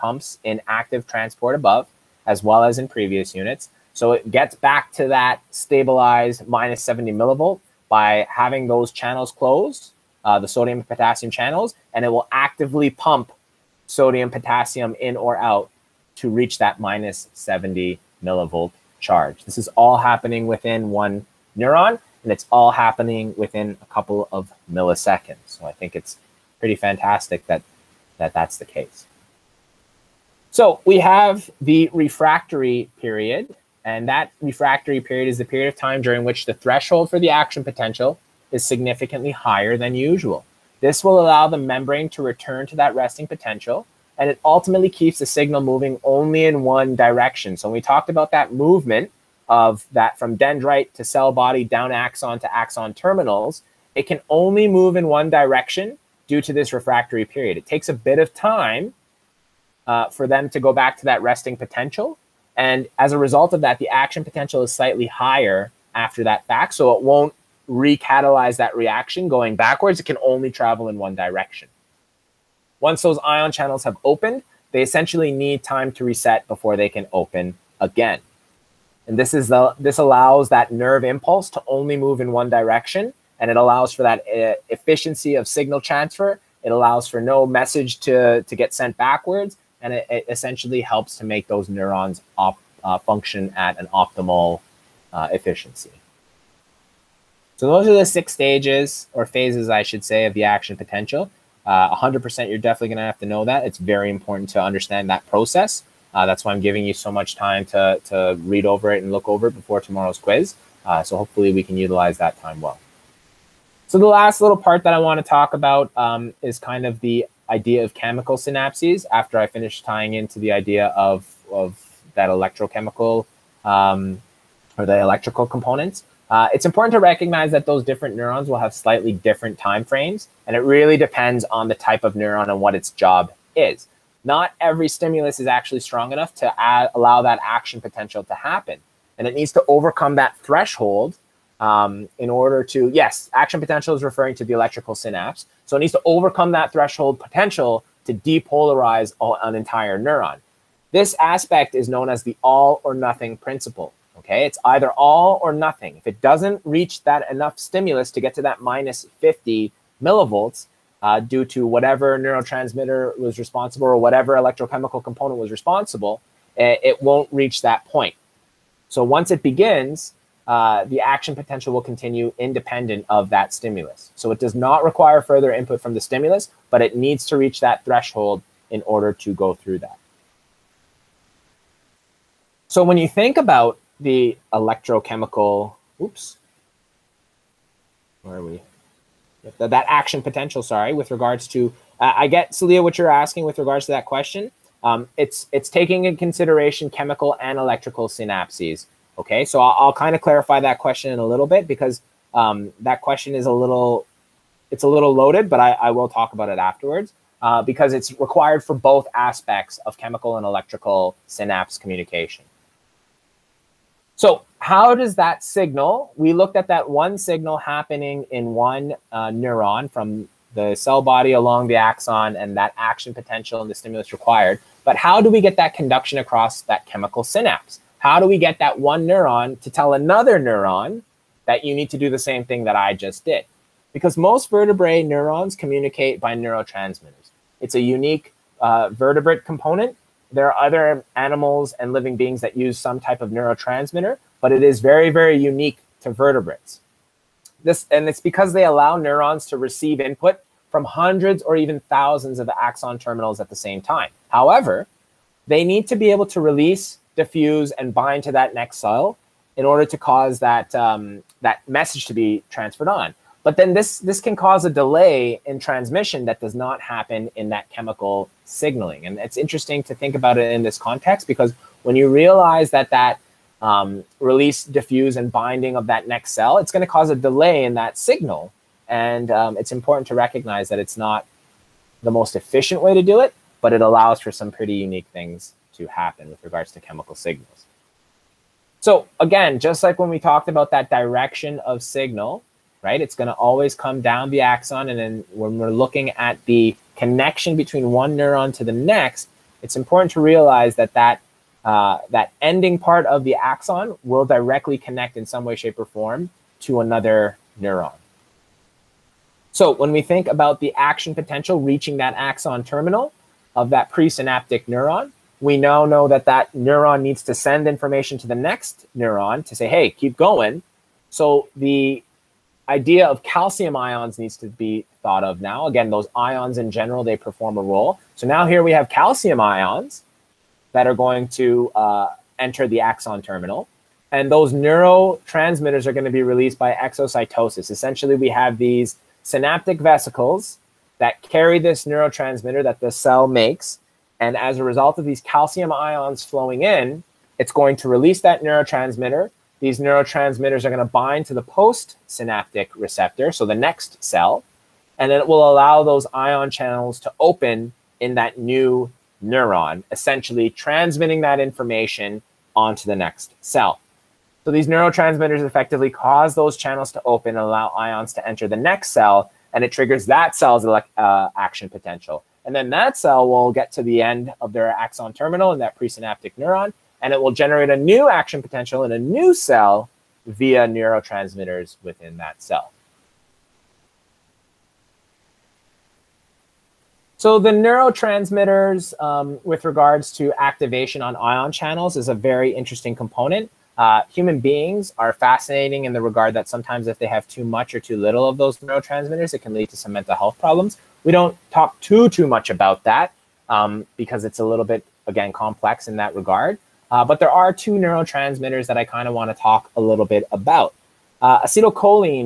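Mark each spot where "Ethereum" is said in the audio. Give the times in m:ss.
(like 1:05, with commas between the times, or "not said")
not said.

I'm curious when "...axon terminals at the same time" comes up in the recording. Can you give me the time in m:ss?
4:12.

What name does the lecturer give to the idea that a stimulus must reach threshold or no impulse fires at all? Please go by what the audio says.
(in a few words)
all or nothing principle.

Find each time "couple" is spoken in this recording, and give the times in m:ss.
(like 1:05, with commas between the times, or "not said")
0:23.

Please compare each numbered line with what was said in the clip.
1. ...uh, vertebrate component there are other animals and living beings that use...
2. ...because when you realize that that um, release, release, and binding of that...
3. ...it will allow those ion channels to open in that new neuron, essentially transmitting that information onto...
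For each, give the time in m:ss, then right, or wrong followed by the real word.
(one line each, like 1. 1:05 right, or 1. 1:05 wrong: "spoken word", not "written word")
1. 3:58 right
2. 4:31 wrong: "diffuse", not "release"
3. 5:55 right.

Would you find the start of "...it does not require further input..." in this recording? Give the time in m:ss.
2:54.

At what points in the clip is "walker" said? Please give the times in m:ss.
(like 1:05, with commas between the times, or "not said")
not said.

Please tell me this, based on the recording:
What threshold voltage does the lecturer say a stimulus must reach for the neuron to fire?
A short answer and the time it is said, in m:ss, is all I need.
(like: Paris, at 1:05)
-50 millivolts, at 2:38.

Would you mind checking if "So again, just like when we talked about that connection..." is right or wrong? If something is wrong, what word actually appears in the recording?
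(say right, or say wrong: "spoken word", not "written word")
wrong: "direction", not "connection".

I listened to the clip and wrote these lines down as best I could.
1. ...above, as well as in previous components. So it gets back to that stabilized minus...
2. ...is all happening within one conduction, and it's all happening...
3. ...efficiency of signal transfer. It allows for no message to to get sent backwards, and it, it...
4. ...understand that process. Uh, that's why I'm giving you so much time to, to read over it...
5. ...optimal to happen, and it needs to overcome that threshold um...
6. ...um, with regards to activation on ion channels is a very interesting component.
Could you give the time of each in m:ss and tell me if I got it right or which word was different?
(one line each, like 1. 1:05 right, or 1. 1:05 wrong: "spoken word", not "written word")
1. 0:01 wrong: "units", not "components"
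2. 0:19 wrong: "neuron", not "conduction"
3. 1:24 right
4. 1:44 right
5. 2:17 wrong: "potential", not "optimal"
6. 6:29 right.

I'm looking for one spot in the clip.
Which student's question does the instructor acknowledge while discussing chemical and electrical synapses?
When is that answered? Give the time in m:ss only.
3:12.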